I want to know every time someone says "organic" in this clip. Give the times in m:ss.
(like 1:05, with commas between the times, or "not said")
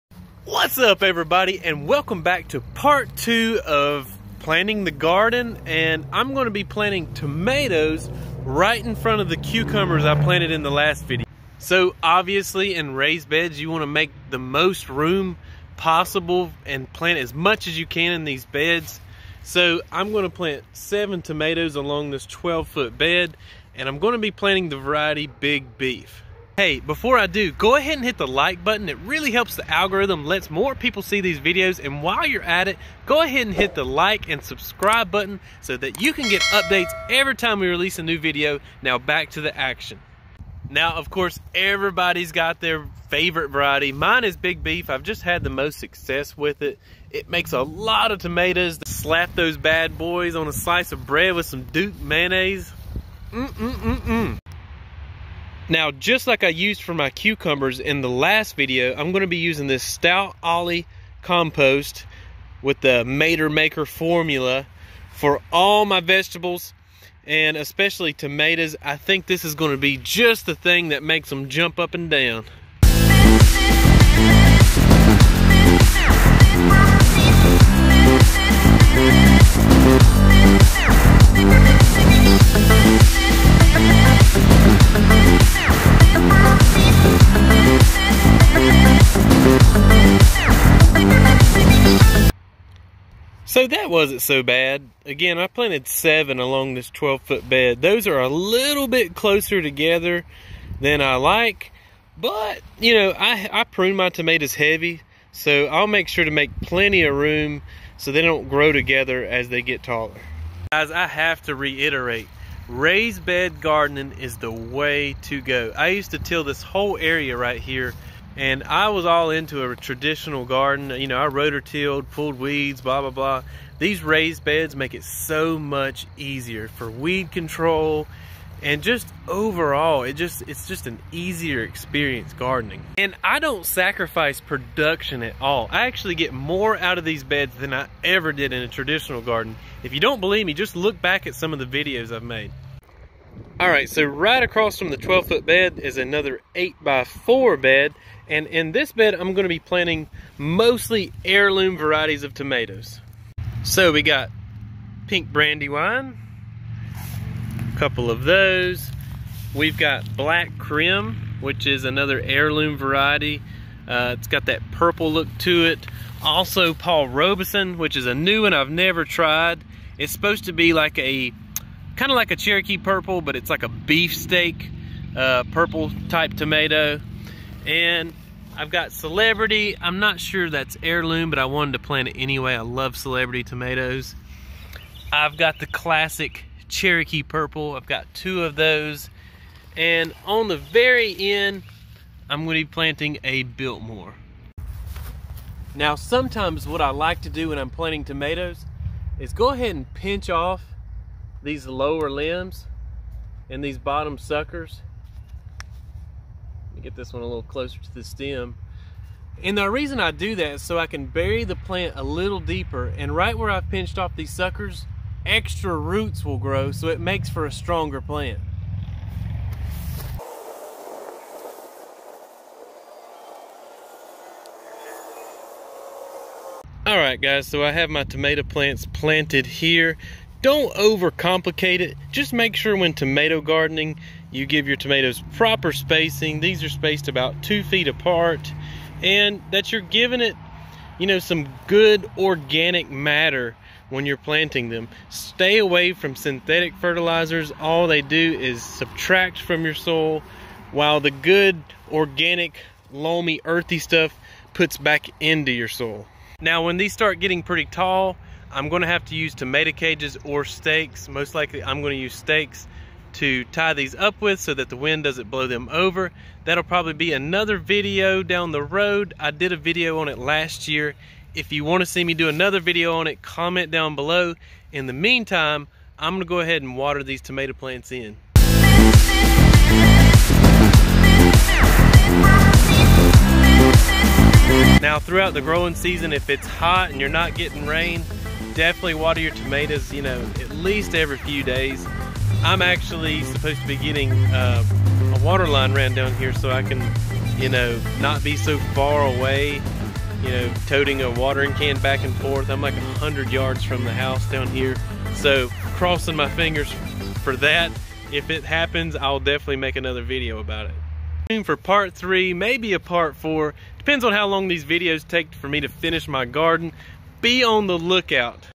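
4:02, 4:11.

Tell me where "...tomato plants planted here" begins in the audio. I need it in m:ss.
3:48.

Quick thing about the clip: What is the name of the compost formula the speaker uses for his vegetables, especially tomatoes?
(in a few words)
Mater Maker.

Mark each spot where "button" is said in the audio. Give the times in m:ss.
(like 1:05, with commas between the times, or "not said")
0:28, 0:35.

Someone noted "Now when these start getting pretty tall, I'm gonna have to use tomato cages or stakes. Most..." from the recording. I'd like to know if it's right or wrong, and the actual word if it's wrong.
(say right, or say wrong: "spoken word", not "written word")
right.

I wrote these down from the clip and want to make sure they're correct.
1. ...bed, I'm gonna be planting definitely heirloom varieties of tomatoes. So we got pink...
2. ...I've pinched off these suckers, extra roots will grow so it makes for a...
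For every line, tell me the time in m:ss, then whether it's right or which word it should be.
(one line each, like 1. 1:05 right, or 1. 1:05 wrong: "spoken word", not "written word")
1. 2:28 wrong: "mostly", not "definitely"
2. 3:33 right.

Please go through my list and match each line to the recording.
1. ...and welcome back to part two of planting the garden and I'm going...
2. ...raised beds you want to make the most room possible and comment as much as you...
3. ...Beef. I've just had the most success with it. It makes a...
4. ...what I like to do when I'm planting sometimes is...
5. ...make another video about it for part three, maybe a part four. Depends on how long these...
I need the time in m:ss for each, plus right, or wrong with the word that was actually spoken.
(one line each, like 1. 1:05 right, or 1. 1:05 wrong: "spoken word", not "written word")
1. 0:01 right
2. 0:12 wrong: "plant", not "comment"
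3. 0:44 right
4. 3:16 wrong: "tomatoes", not "sometimes"
5. 5:09 right.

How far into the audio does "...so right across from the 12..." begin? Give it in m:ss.
2:23.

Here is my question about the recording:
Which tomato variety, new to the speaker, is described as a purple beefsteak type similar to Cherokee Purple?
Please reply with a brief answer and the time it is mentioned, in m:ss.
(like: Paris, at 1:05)
Paul Robeson, at 2:46.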